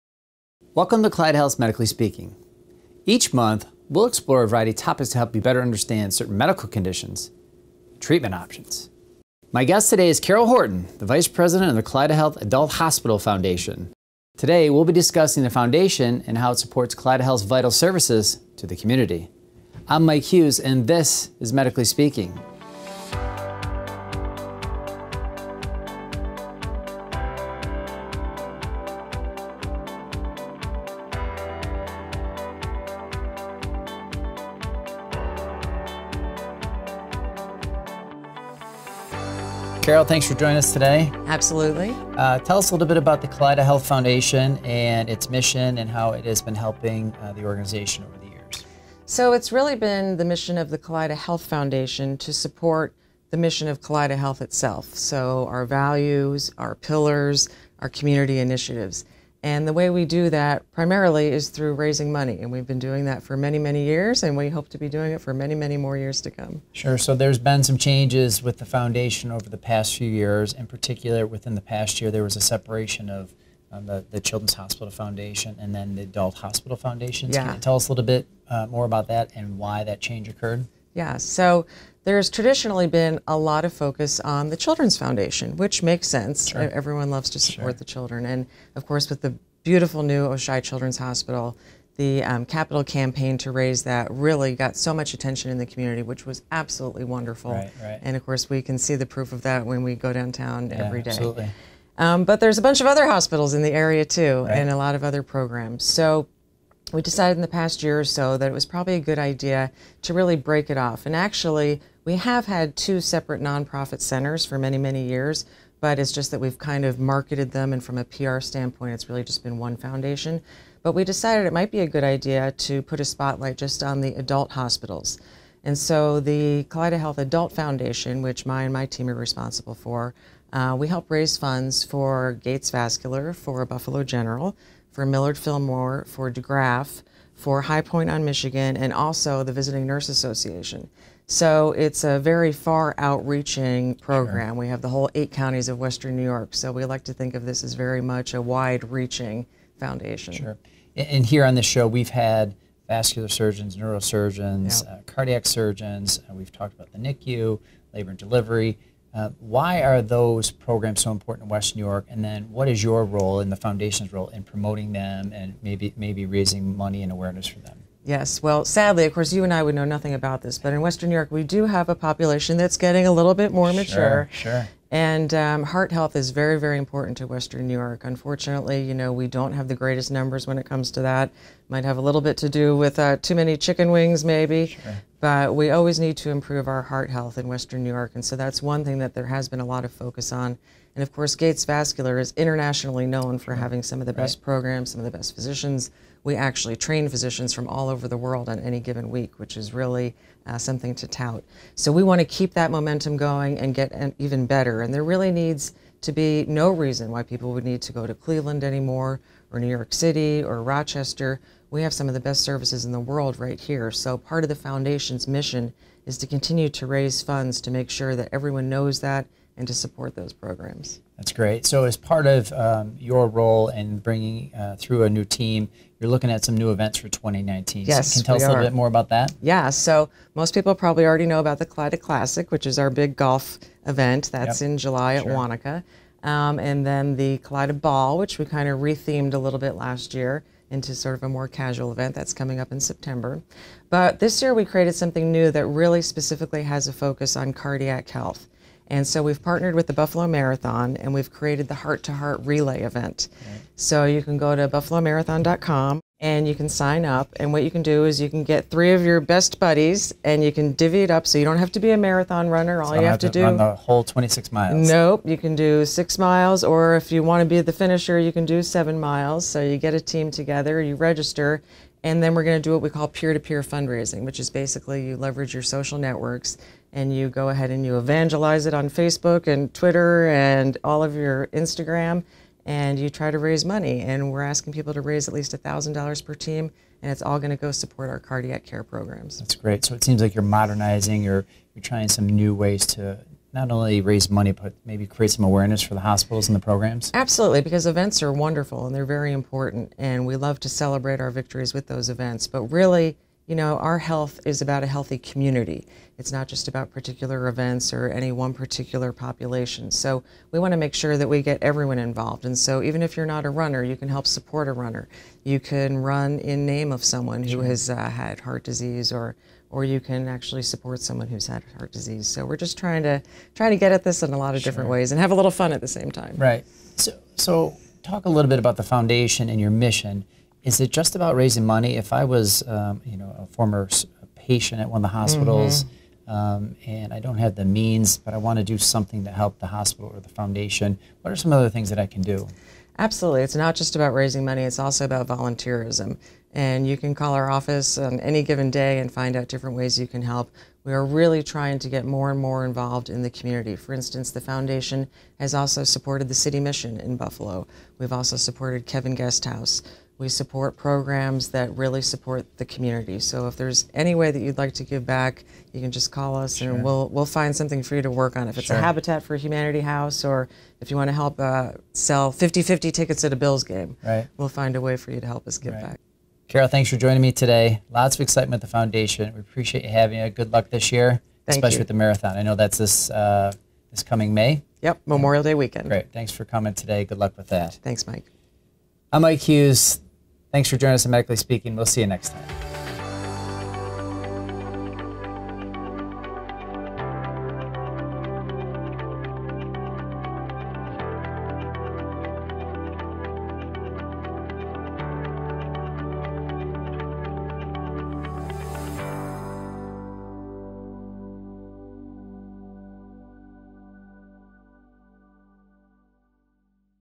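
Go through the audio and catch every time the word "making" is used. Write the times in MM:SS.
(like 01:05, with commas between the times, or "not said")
not said.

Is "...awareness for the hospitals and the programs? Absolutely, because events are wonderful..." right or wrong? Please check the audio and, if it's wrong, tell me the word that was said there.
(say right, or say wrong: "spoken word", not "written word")
right.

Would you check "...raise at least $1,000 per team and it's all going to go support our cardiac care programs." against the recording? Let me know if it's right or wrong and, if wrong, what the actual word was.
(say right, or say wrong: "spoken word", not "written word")
right.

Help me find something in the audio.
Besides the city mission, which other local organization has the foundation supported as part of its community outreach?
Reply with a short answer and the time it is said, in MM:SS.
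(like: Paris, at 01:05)
Kevin Guest House, at 05:58.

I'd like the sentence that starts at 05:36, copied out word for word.
um, and I don't have the means, but I want to do something to help the hospital or the foundation.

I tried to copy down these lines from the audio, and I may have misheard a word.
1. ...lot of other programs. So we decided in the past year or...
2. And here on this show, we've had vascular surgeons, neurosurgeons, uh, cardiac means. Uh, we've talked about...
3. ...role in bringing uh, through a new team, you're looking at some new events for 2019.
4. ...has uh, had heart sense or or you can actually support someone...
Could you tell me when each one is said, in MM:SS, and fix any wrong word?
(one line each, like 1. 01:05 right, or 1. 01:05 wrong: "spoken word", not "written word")
1. 01:44 right
2. 02:30 wrong: "surgeons", not "means"
3. 03:43 right
4. 05:17 wrong: "disease", not "sense".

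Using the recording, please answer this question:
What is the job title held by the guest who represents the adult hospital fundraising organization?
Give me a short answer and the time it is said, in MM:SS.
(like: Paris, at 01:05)
Vice President, at 00:11.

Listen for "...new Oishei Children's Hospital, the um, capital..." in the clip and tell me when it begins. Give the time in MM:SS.
01:30.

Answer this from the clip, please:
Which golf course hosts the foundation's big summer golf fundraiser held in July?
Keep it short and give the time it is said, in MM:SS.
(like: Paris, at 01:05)
Wanakah, at 03:55.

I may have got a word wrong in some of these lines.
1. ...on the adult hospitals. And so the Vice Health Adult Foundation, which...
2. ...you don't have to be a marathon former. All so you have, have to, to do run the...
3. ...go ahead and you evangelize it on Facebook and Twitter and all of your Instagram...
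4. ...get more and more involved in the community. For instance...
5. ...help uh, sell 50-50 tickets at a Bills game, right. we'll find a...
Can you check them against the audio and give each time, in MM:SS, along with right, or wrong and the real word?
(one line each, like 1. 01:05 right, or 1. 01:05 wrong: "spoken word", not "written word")
1. 02:03 wrong: "Kaleida", not "Vice"
2. 04:21 wrong: "runner", not "former"
3. 04:37 right
4. 05:51 right
5. 06:11 right.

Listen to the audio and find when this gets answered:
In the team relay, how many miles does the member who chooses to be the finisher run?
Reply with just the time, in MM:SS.
04:28.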